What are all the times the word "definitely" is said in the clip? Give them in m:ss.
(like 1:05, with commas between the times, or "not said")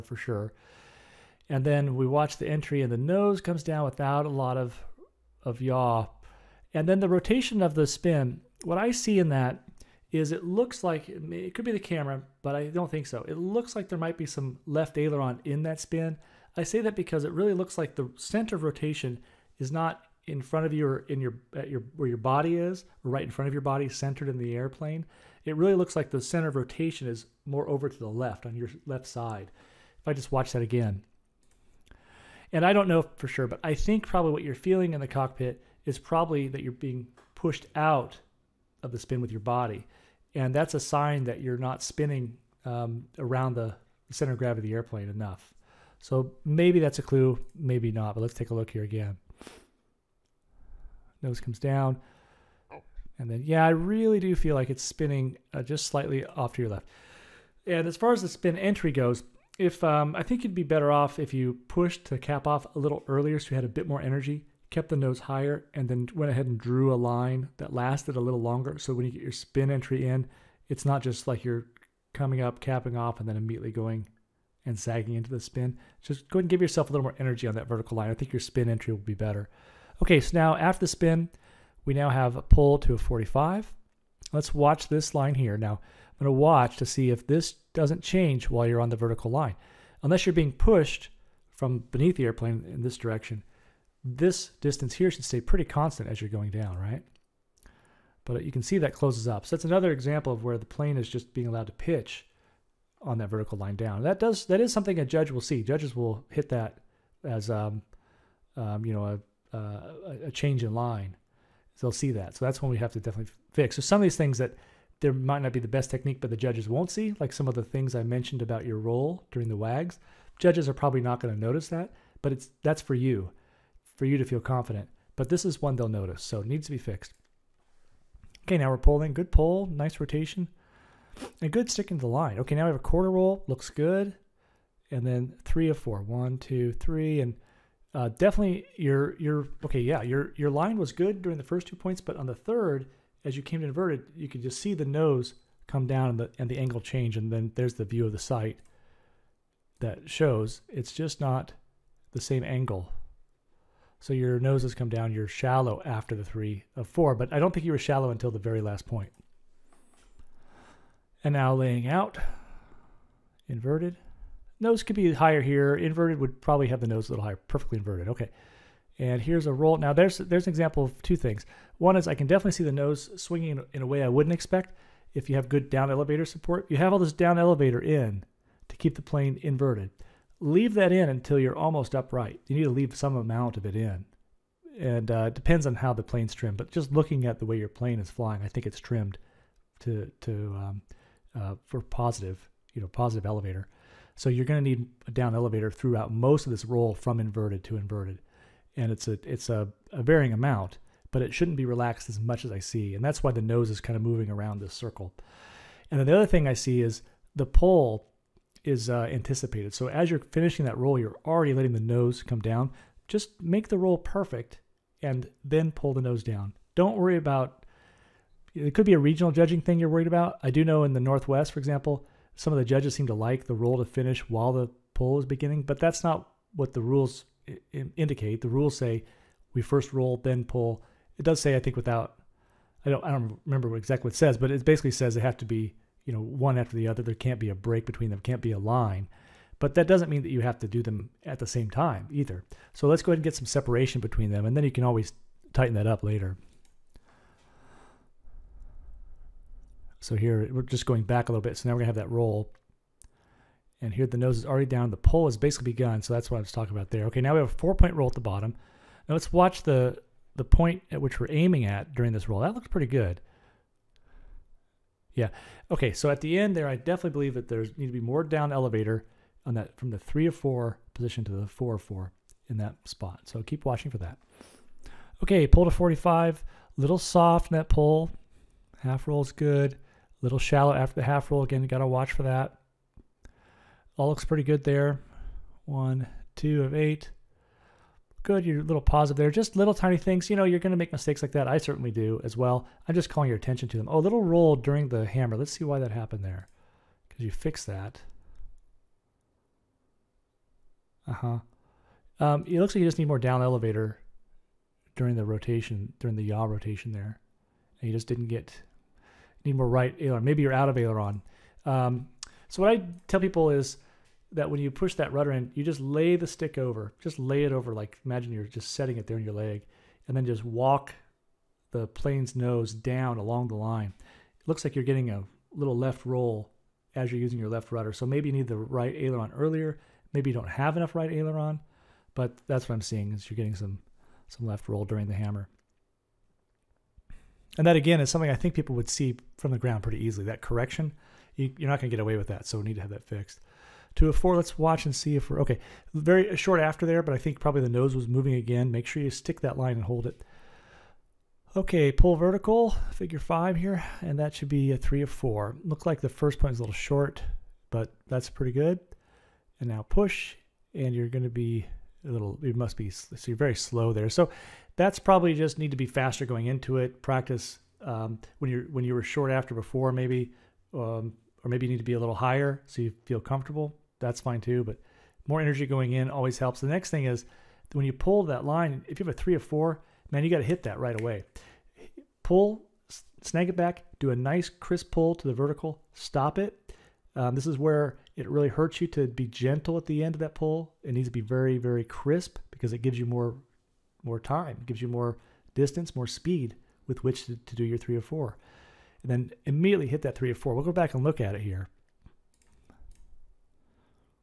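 1:52, 2:18, 2:52, 4:26.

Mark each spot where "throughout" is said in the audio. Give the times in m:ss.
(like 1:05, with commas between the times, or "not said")
3:15.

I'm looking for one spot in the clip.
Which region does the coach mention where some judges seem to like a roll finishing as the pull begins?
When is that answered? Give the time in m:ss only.
3:40.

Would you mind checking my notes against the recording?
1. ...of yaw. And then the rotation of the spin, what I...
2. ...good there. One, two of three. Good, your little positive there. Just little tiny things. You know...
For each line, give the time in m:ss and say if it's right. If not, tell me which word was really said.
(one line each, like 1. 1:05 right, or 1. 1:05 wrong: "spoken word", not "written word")
1. 0:05 right
2. 4:44 wrong: "eight", not "three".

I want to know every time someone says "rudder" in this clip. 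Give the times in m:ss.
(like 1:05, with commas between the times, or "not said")
5:15, 5:27.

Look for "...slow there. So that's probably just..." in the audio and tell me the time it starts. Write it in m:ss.
6:03.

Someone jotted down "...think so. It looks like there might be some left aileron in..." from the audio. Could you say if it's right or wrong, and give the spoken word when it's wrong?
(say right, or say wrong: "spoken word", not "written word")
right.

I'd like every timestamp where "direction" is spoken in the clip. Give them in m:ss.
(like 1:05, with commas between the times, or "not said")
1:32.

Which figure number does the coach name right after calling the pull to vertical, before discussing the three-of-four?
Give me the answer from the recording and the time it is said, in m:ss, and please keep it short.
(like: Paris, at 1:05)
figure 5, at 5:52.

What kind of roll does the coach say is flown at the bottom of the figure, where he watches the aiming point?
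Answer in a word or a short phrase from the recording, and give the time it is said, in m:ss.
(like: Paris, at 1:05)
Four point roll, at 4:17.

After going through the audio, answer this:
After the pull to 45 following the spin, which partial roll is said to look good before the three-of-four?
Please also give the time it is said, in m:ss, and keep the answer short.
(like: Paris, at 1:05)
quarter roll, at 2:12.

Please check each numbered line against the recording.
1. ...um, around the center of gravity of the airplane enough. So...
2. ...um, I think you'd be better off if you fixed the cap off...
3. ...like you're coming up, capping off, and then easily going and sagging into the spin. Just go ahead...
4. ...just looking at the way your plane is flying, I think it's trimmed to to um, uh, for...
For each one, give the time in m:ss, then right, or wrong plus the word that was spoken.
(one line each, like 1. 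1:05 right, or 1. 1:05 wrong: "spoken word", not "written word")
1. 0:42 right
2. 0:59 wrong: "pushed", not "fixed"
3. 1:11 wrong: "immediately", not "easily"
4. 3:06 right.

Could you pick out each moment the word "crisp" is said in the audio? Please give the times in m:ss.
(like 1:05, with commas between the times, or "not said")
6:24, 6:31.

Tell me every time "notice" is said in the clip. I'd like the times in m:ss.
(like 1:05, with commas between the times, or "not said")
2:01, 2:05.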